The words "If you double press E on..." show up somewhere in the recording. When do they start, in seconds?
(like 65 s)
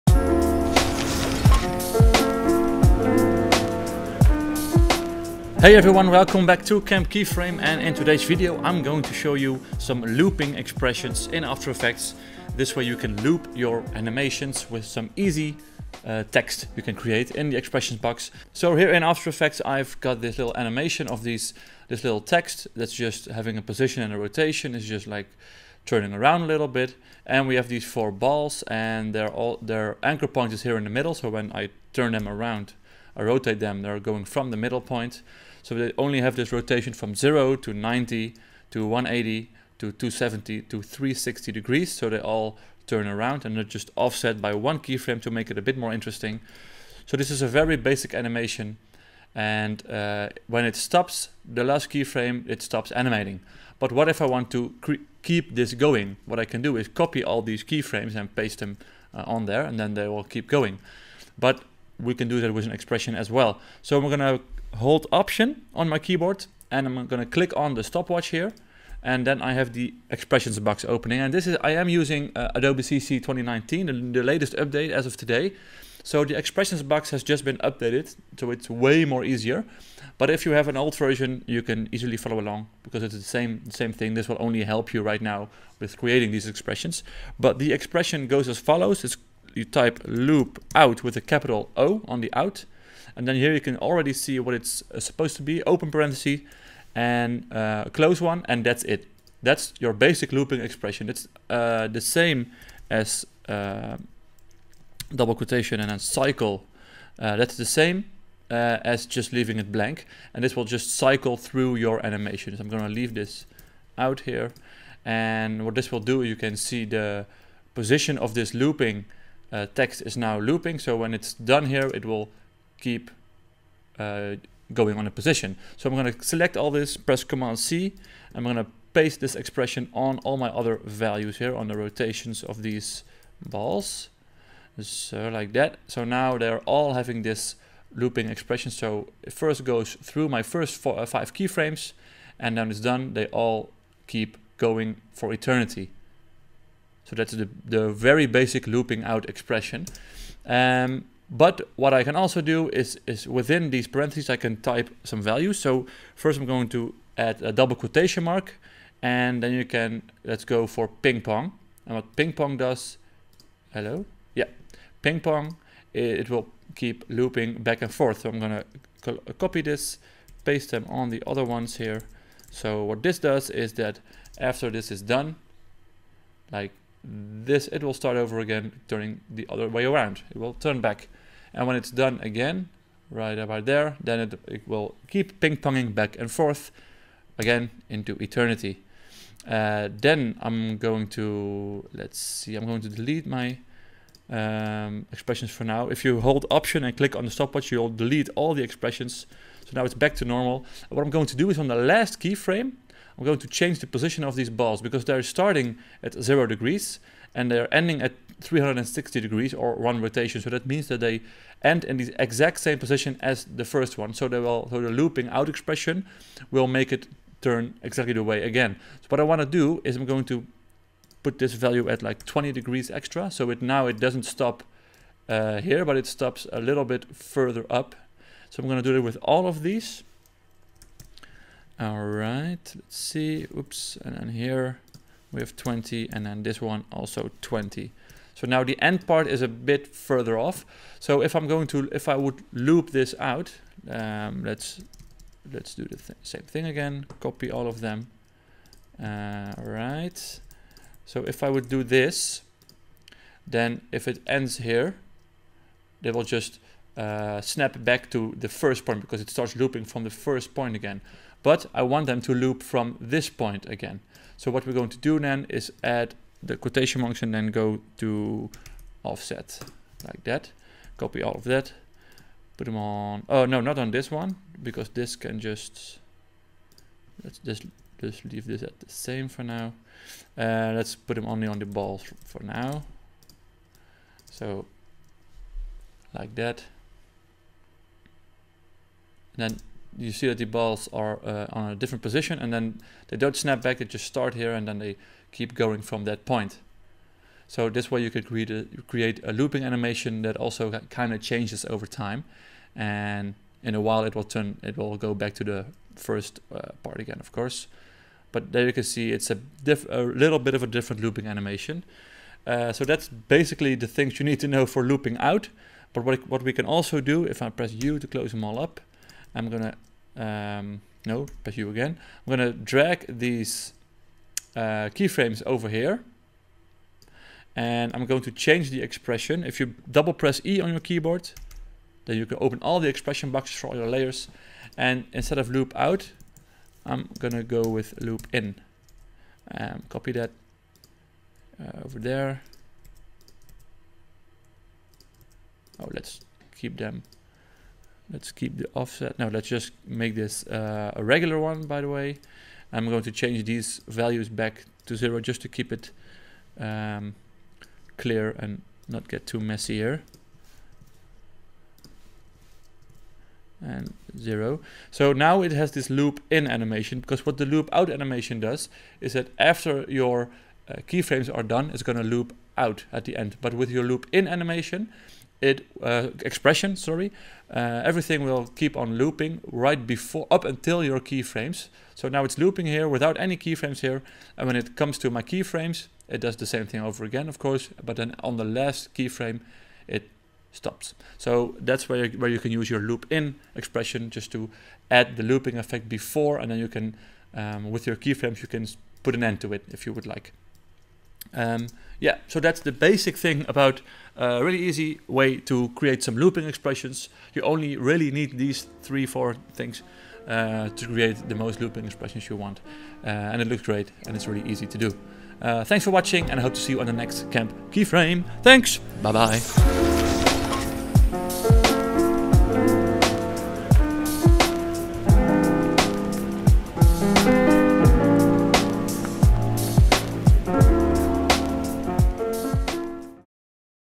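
329 s.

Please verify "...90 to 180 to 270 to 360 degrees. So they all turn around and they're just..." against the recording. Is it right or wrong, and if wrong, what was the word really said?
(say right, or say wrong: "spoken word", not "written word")
right.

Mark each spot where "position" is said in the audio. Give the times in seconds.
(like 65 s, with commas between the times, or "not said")
23 s, 117 s, 125 s, 203 s, 212 s, 292 s.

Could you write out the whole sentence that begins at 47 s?
So this is a very basic animation.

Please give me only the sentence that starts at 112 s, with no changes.
I'm gonna leave this out here.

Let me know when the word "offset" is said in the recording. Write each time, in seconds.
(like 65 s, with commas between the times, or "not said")
43 s, 269 s, 348 s.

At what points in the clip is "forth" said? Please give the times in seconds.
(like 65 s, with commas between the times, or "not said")
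167 s, 186 s.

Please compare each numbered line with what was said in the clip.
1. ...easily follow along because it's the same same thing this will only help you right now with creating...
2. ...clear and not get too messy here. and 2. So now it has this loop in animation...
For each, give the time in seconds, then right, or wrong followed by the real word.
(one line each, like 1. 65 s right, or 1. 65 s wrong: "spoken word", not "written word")
1. 81 s right
2. 357 s wrong: "0", not "2".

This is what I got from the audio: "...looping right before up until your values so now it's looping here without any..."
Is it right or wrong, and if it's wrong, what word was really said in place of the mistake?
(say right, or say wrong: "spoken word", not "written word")
wrong: "keyframes", not "values".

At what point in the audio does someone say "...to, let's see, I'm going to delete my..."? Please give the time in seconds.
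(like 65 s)
191 s.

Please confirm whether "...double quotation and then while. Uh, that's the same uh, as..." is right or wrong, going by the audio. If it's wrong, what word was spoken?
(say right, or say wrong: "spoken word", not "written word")
wrong: "cycle", not "while".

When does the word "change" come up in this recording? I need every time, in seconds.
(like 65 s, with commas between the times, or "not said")
203 s, 301 s, 328 s, 353 s.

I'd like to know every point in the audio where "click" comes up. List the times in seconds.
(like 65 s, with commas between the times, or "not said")
67 s, 196 s.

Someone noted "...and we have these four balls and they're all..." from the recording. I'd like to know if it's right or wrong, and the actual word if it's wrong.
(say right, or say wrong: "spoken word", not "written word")
right.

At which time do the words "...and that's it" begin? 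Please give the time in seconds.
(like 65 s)
98 s.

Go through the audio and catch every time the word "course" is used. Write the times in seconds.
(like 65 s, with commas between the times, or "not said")
307 s, 387 s.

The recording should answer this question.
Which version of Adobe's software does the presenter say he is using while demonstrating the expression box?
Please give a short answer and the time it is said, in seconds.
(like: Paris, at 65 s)
Adobe CC 2019, at 72 s.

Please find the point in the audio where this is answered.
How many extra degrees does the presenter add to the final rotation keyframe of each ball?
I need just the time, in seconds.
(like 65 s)
222 s.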